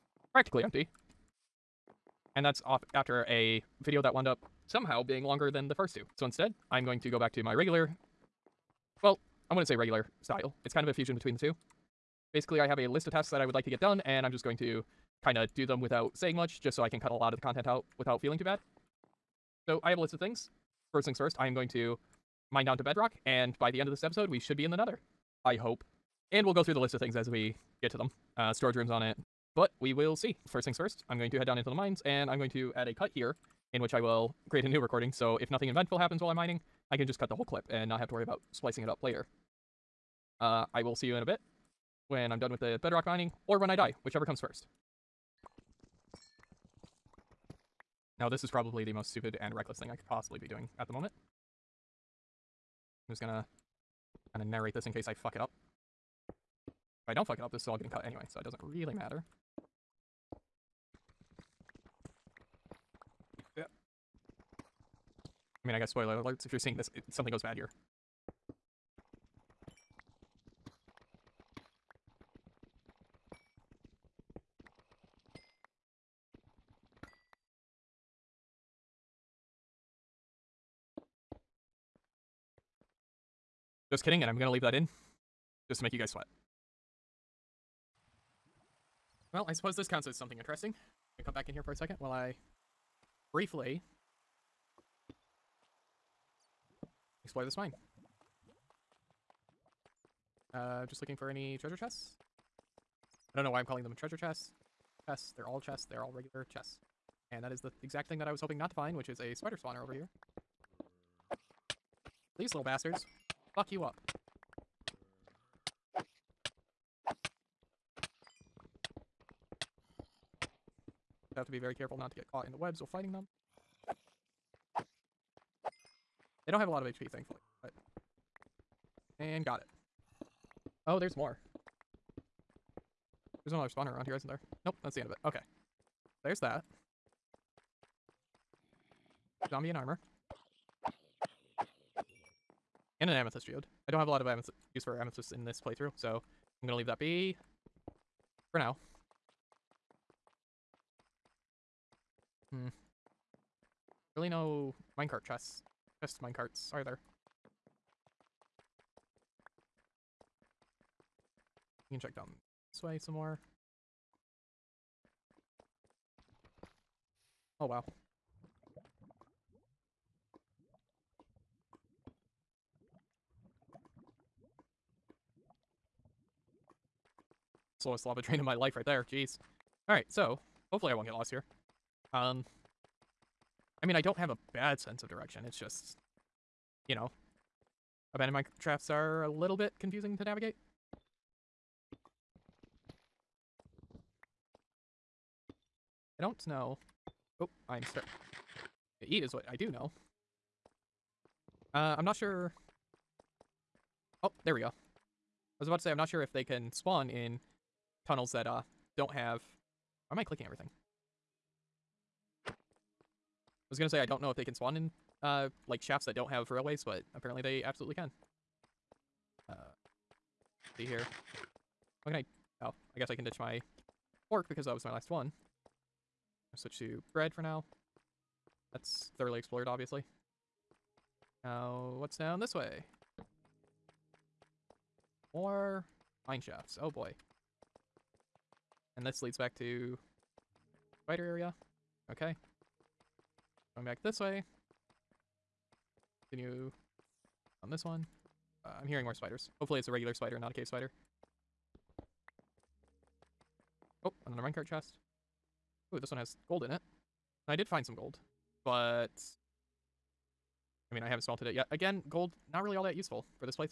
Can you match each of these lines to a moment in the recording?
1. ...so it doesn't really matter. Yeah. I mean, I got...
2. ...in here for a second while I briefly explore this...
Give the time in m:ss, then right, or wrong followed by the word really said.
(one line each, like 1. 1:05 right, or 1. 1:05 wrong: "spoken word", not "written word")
1. 0:58 right
2. 1:31 right.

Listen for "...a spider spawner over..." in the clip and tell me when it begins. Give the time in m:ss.
1:49.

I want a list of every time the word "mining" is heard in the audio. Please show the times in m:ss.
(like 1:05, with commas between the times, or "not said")
0:36, 0:43.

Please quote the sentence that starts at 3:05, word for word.
It's just, you know, abandoned mineshafts are a little bit confusing to navigate.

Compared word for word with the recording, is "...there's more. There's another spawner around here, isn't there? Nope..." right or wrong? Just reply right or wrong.
right.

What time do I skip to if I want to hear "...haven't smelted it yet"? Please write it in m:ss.
4:21.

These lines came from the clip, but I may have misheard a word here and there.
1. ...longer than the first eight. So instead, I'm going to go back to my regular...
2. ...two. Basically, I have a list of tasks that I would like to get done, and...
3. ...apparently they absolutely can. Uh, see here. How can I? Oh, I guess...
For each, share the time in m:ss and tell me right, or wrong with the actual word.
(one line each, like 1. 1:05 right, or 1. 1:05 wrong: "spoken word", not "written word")
1. 0:05 wrong: "two", not "eight"
2. 0:11 right
3. 3:37 right.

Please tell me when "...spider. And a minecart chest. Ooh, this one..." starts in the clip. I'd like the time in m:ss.
4:10.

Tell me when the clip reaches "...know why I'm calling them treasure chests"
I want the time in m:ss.
1:43.